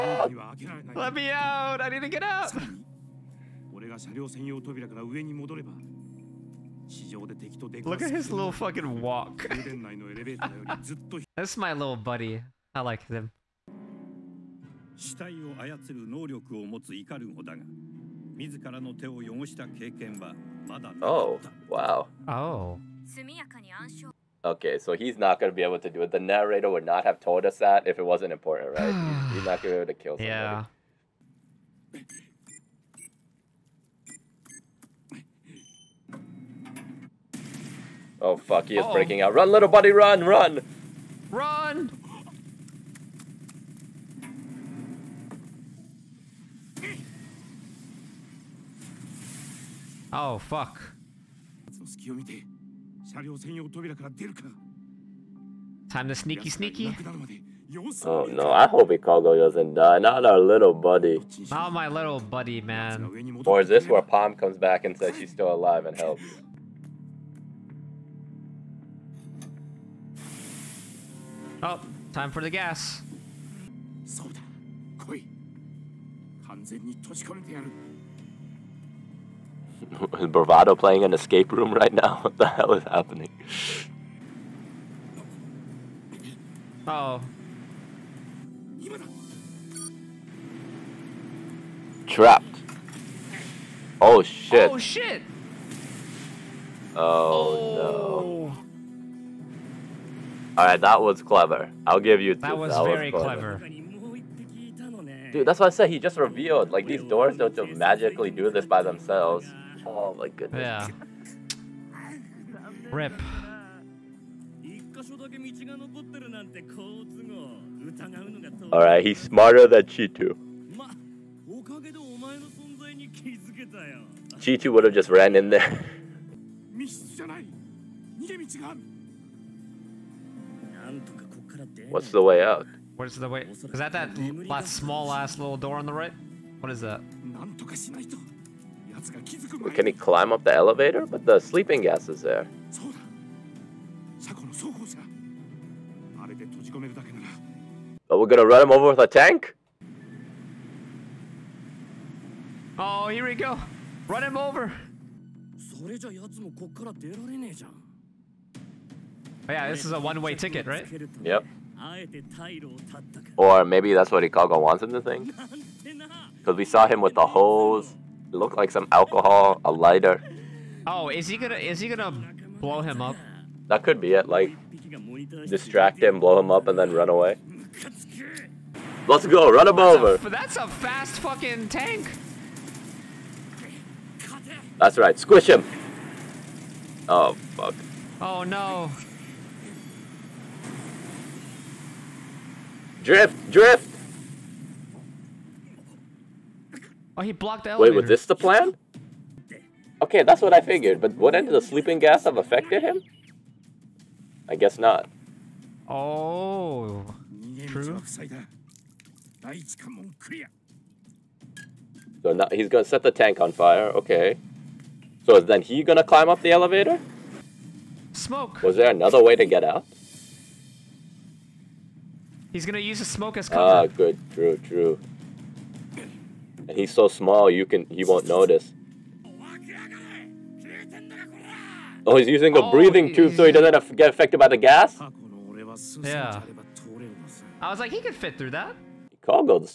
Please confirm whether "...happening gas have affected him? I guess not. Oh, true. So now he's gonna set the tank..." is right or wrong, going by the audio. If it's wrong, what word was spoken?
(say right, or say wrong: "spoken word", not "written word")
wrong: "sleeping", not "happening".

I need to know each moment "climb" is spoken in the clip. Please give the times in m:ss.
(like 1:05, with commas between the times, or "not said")
2:19, 3:36.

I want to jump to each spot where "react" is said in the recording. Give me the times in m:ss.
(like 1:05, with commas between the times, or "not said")
not said.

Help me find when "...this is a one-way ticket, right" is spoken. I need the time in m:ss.
2:39.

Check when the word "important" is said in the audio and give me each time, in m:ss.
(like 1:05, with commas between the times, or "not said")
0:28.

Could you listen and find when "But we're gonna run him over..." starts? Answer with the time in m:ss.
2:28.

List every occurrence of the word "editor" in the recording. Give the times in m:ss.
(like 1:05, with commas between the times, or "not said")
not said.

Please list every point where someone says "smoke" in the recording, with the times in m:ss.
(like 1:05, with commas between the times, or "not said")
3:38, 3:43.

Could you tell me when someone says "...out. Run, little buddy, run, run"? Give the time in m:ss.
0:39.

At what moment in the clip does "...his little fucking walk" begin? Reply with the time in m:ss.
0:08.